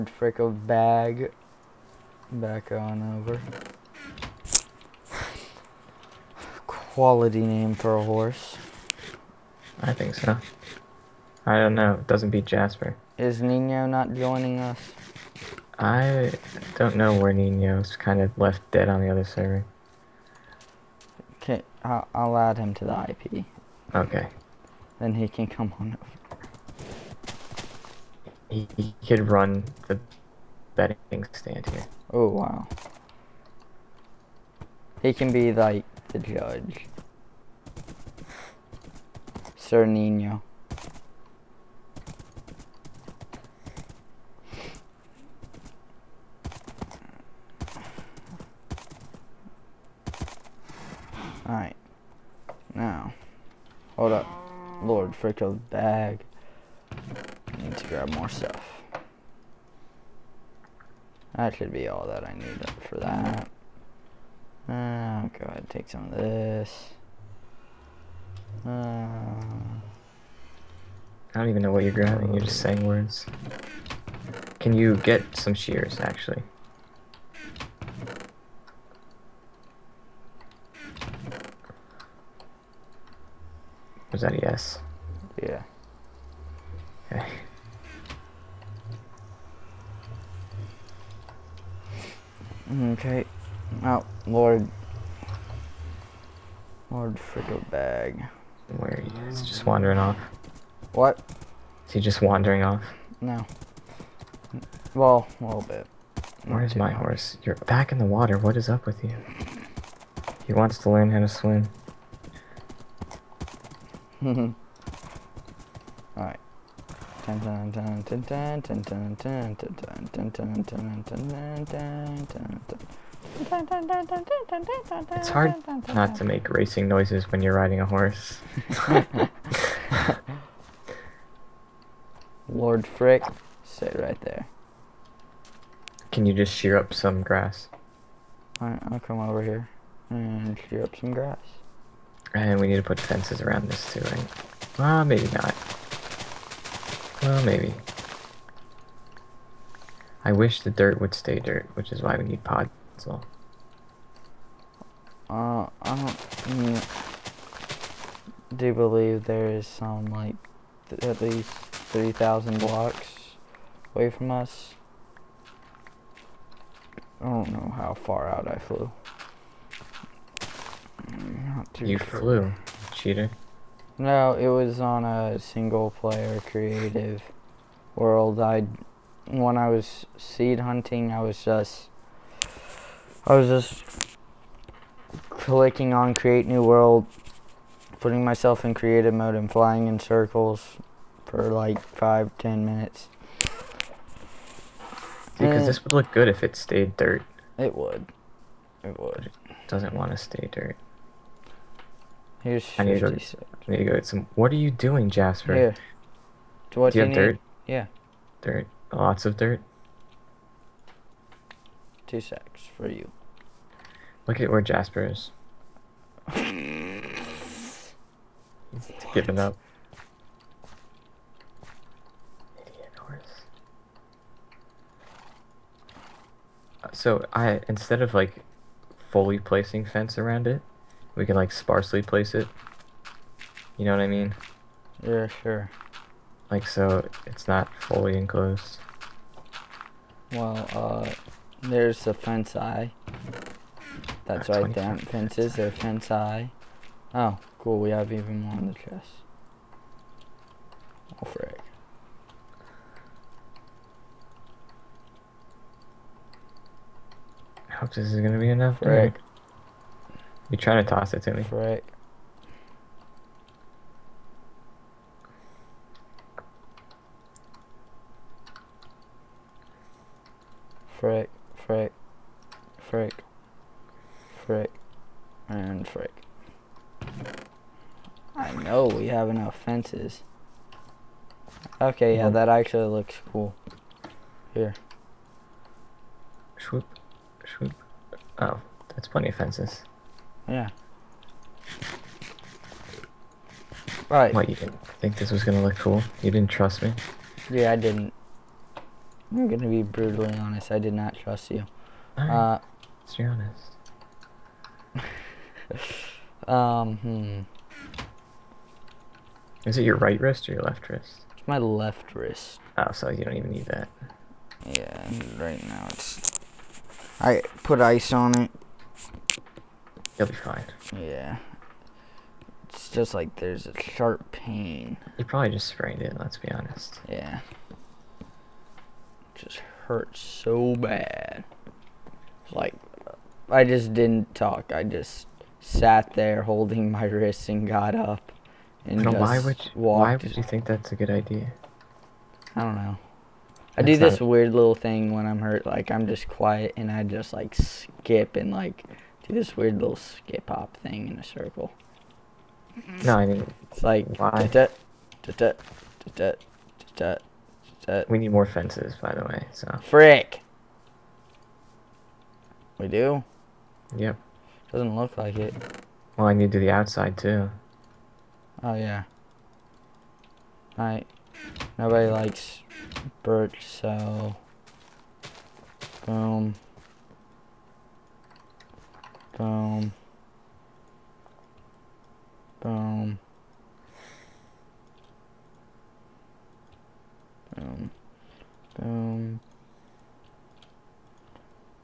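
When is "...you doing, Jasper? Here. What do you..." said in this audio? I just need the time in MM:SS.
03:24.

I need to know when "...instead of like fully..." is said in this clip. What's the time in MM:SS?
03:47.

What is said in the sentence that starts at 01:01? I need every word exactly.
That should be all that I need for that.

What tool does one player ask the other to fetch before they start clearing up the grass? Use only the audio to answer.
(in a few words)
Shears.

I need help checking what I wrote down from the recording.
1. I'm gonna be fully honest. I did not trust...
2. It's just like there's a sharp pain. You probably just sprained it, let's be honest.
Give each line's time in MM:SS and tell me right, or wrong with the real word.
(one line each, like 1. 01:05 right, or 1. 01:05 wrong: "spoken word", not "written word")
1. 04:59 wrong: "brutally", not "fully"
2. 05:22 right.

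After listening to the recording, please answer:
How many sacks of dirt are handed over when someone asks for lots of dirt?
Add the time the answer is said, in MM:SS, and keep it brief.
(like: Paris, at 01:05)
2, at 03:32.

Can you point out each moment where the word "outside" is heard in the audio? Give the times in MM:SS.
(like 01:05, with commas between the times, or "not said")
06:06.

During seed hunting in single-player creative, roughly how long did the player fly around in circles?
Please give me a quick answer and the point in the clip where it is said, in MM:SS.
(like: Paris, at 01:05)
5 to 10 minutes, at 03:11.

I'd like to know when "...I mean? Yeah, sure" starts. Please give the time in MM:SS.
03:53.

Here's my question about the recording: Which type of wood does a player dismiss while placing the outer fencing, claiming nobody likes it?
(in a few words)
Birch.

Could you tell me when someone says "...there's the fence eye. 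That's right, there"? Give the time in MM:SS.
04:01.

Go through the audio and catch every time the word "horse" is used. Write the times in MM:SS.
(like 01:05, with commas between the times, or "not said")
00:08, 01:46, 02:07, 03:42.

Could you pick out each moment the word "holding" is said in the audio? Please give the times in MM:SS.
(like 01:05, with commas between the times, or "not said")
05:36.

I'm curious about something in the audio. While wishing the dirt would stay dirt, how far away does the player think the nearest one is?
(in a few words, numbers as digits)
3000 blocks.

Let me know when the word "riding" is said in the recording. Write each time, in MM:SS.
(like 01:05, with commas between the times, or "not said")
02:07.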